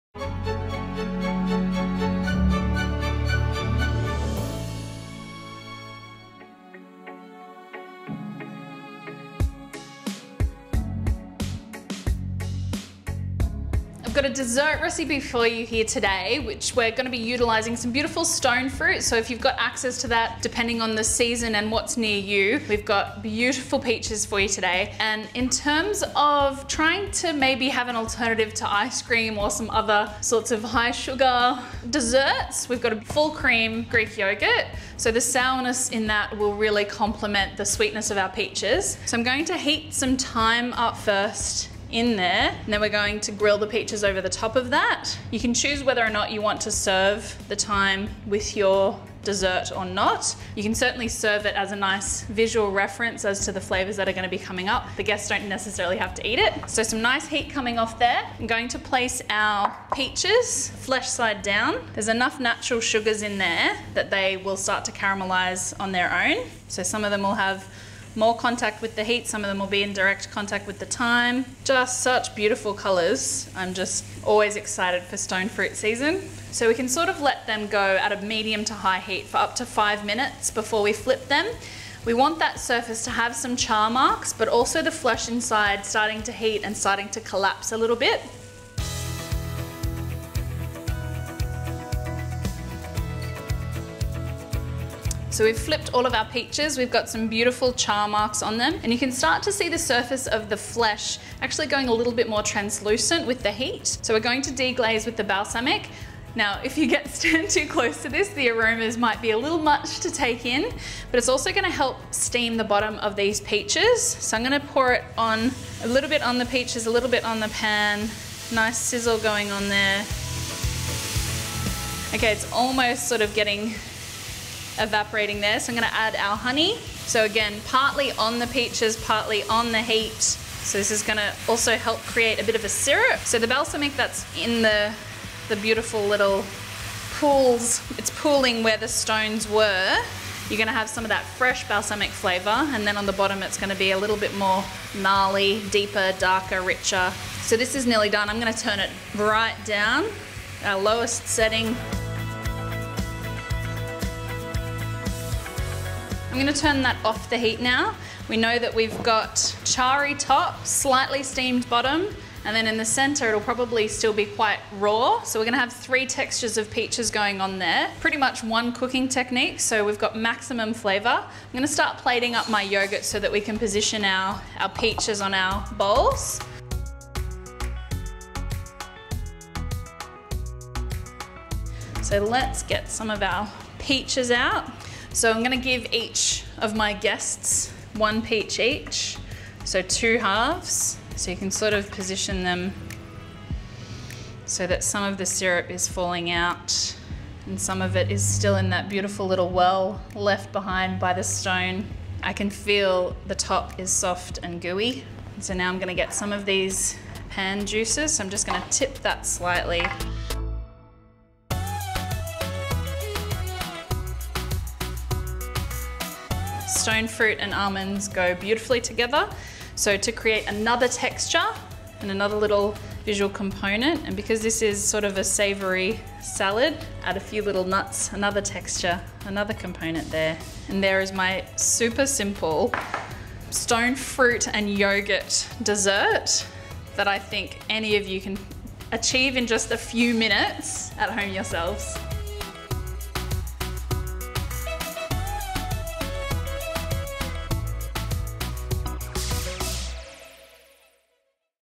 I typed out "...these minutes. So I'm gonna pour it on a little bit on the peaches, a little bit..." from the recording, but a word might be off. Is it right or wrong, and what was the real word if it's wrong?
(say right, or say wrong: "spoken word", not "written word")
wrong: "peaches", not "minutes".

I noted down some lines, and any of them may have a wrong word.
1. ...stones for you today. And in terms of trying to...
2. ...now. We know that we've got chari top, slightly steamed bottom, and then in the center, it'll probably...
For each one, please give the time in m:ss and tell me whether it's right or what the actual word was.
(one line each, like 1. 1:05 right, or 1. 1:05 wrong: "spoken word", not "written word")
1. 0:23 wrong: "peaches", not "stones"
2. 2:37 right.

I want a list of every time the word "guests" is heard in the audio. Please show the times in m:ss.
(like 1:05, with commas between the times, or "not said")
0:55, 3:06.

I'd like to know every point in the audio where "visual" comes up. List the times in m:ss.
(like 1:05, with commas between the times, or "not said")
0:52, 3:43.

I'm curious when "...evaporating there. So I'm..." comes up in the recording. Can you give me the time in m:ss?
2:04.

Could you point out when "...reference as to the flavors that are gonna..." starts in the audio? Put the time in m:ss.
0:52.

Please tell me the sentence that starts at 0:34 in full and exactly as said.
So the sourness in that will really complement the sweetness of our peaches.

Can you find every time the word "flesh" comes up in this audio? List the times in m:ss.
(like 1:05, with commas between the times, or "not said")
1:00, 1:24, 1:40.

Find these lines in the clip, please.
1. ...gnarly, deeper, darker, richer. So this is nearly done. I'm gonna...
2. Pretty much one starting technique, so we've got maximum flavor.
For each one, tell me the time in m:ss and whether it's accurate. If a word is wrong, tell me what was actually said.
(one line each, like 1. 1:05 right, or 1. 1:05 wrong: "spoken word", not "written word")
1. 2:24 right
2. 2:47 wrong: "cooking", not "starting".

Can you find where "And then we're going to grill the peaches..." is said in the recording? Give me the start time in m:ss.
0:42.